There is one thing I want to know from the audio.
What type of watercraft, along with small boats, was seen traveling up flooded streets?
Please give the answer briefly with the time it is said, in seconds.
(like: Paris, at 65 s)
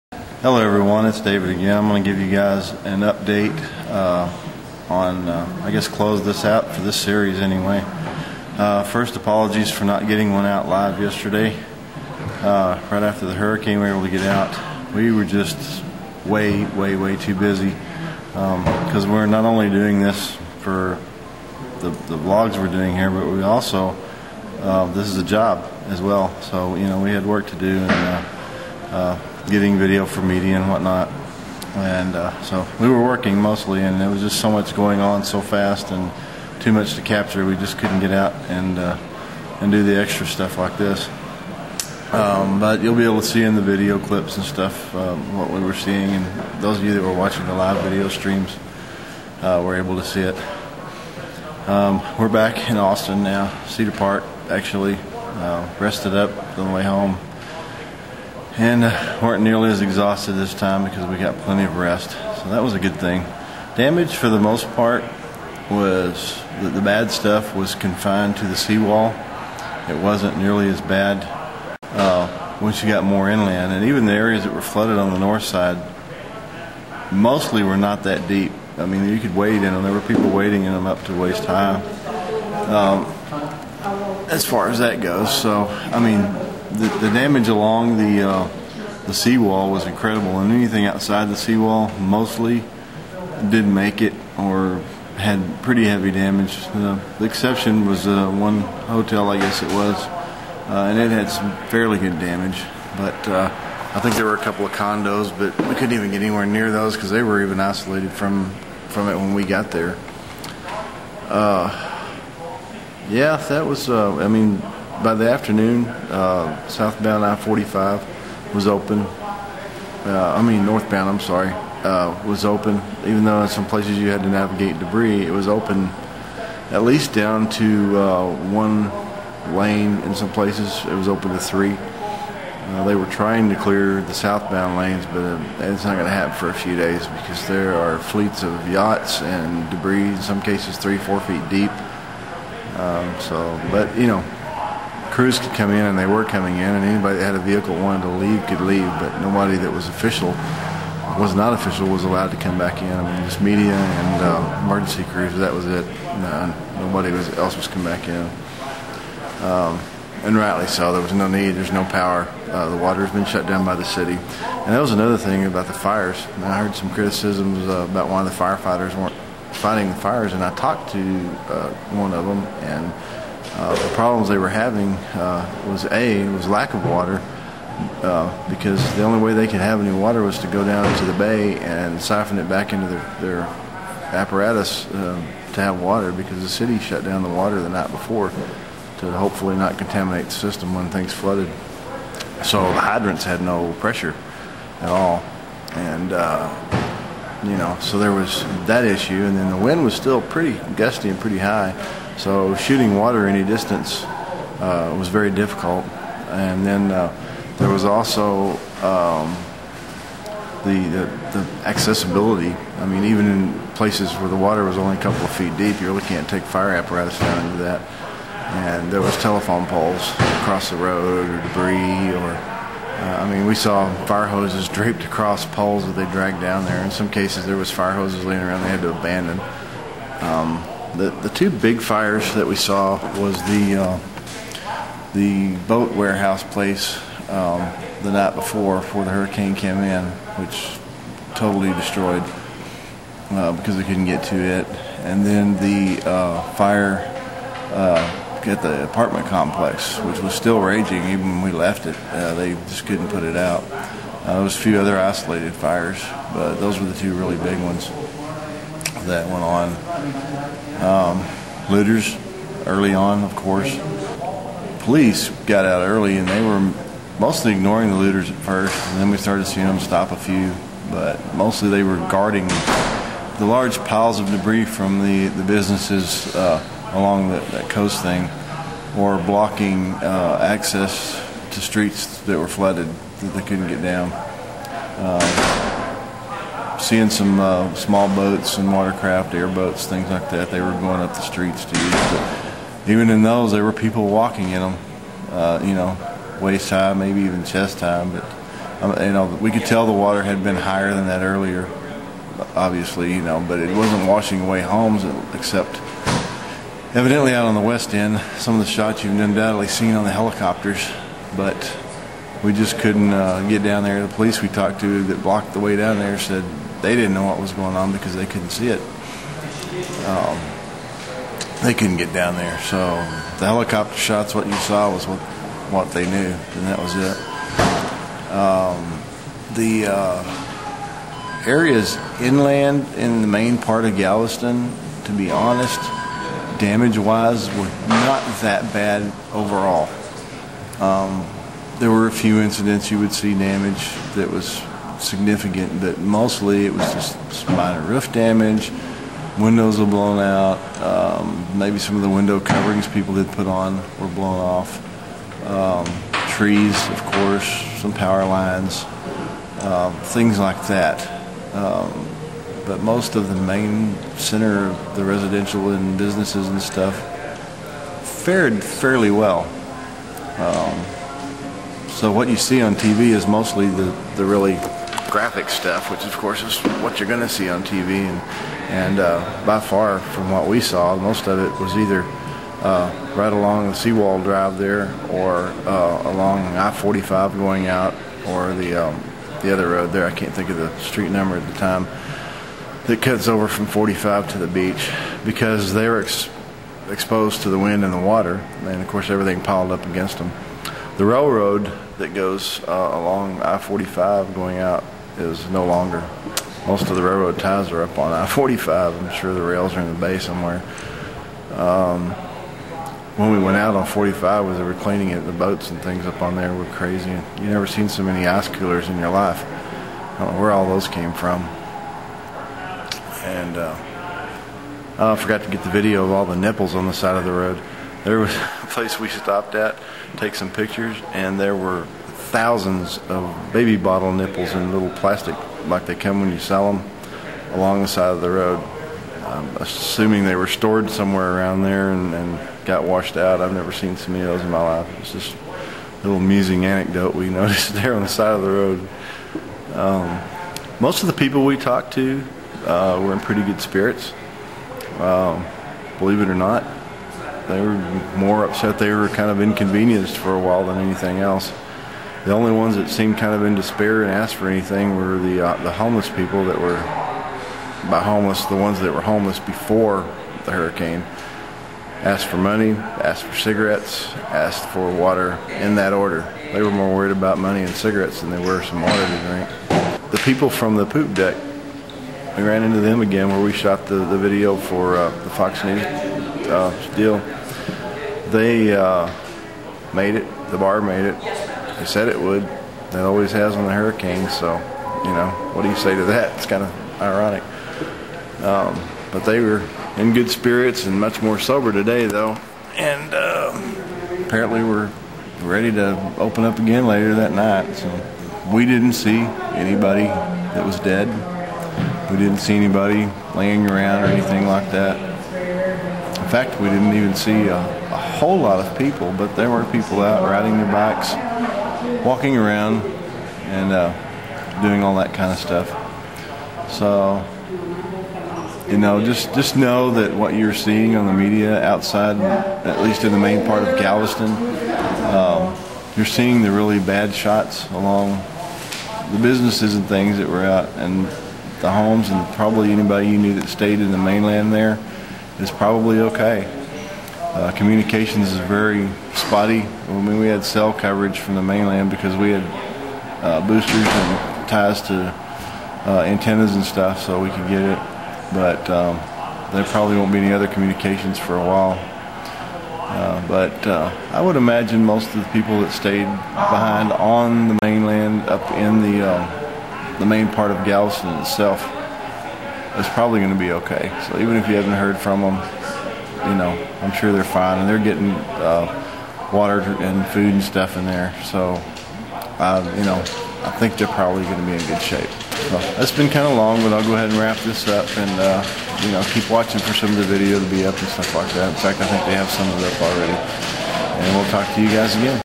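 airboats, at 289 s.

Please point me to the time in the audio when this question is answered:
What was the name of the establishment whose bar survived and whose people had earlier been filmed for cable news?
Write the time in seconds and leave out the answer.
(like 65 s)
480 s.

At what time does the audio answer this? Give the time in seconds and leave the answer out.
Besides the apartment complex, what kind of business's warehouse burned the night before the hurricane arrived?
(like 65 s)
235 s.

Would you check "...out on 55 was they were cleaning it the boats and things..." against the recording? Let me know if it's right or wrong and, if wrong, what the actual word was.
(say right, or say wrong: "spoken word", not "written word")
wrong: "45", not "55".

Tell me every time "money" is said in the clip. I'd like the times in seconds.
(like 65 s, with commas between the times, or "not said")
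472 s, 477 s.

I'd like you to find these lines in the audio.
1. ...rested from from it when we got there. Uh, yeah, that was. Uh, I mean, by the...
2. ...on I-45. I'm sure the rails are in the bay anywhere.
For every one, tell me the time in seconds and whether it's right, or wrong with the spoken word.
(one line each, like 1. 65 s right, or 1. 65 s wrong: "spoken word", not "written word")
1. 107 s wrong: "isolated", not "rested"
2. 407 s wrong: "somewhere", not "anywhere".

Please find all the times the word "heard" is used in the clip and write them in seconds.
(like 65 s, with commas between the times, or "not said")
166 s, 574 s.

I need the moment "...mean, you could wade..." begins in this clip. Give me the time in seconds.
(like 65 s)
78 s.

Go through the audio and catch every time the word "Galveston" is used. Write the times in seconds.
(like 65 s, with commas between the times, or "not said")
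333 s, 533 s, 570 s.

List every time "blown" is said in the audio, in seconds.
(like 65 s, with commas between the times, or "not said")
349 s, 354 s.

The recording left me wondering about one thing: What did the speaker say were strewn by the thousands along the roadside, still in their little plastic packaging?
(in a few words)
baby bottle nipples.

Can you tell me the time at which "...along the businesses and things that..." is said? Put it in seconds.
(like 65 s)
537 s.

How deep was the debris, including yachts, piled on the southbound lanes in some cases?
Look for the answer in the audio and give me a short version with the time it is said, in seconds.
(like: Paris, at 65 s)
3 to 4 feet, at 140 s.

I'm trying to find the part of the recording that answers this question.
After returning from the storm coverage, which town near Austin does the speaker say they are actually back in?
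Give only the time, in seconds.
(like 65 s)
53 s.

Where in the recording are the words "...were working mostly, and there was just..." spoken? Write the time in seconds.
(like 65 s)
32 s.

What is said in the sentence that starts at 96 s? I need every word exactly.
Uh, the exception was uh, one hotel, I guess it was, uh, and it had some fairly good damage.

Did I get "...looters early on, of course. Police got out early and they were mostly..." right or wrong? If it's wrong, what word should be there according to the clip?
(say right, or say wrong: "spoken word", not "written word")
right.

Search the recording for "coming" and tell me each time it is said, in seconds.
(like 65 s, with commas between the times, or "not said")
146 s, 157 s.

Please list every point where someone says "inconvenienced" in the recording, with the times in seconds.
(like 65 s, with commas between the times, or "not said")
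459 s.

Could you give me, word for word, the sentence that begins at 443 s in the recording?
I've never seen so many of those in my life.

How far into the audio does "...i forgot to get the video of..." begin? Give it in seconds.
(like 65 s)
424 s.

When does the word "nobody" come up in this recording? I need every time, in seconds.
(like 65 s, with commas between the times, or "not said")
149 s, 156 s.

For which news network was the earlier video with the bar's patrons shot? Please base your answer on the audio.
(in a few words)
Fox News.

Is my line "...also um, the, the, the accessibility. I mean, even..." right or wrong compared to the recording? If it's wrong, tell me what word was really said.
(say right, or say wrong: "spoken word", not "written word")
right.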